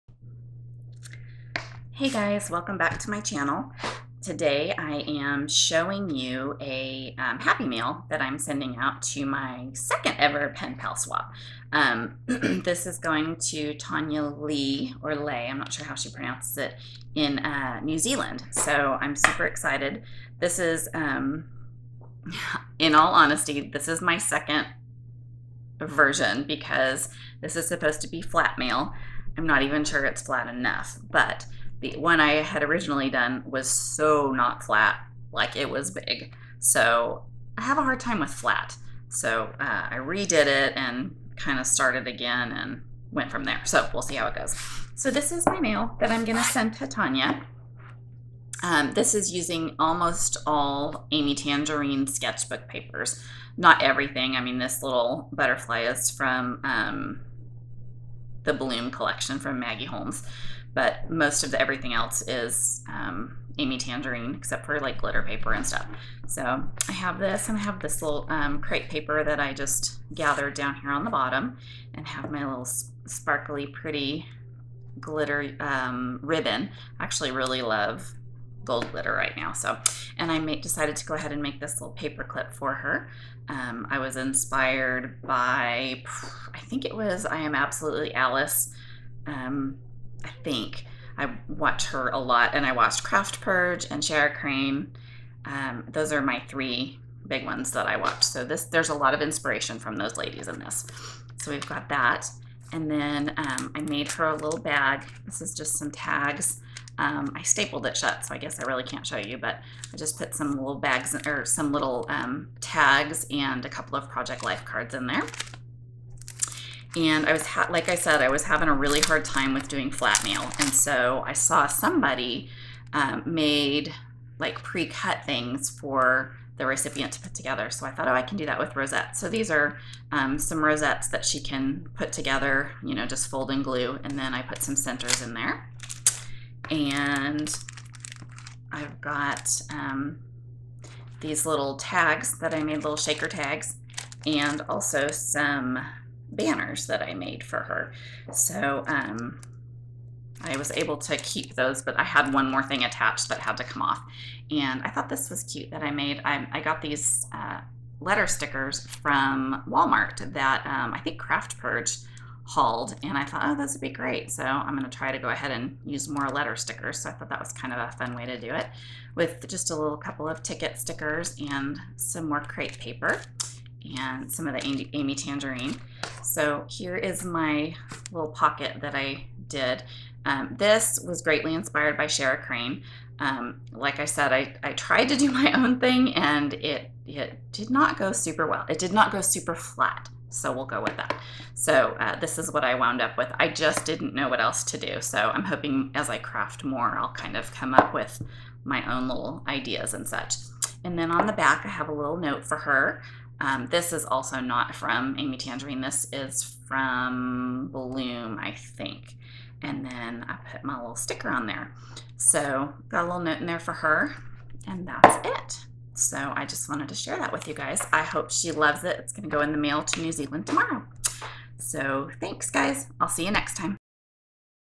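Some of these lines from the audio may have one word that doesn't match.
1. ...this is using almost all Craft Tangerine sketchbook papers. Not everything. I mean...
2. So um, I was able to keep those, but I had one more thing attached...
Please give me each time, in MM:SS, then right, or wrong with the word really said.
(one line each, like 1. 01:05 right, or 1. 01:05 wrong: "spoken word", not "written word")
1. 00:48 wrong: "Amy", not "Craft"
2. 02:28 right.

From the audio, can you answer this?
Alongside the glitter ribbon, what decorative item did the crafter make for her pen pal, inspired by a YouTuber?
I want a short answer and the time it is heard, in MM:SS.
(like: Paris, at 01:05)
paper clip, at 01:21.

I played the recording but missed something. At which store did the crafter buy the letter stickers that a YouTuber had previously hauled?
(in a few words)
Walmart.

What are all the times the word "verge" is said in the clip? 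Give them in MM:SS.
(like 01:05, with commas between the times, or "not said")
not said.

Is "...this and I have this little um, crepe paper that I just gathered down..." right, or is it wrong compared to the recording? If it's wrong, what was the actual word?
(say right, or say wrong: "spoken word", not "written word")
right.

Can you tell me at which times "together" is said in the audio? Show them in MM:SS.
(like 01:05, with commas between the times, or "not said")
02:07, 02:12.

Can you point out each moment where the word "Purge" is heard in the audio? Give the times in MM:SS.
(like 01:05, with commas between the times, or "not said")
01:33, 02:41.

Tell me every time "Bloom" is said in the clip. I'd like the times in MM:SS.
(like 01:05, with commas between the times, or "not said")
00:58, 03:27.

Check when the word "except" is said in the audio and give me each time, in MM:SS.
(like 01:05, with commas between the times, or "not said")
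01:04.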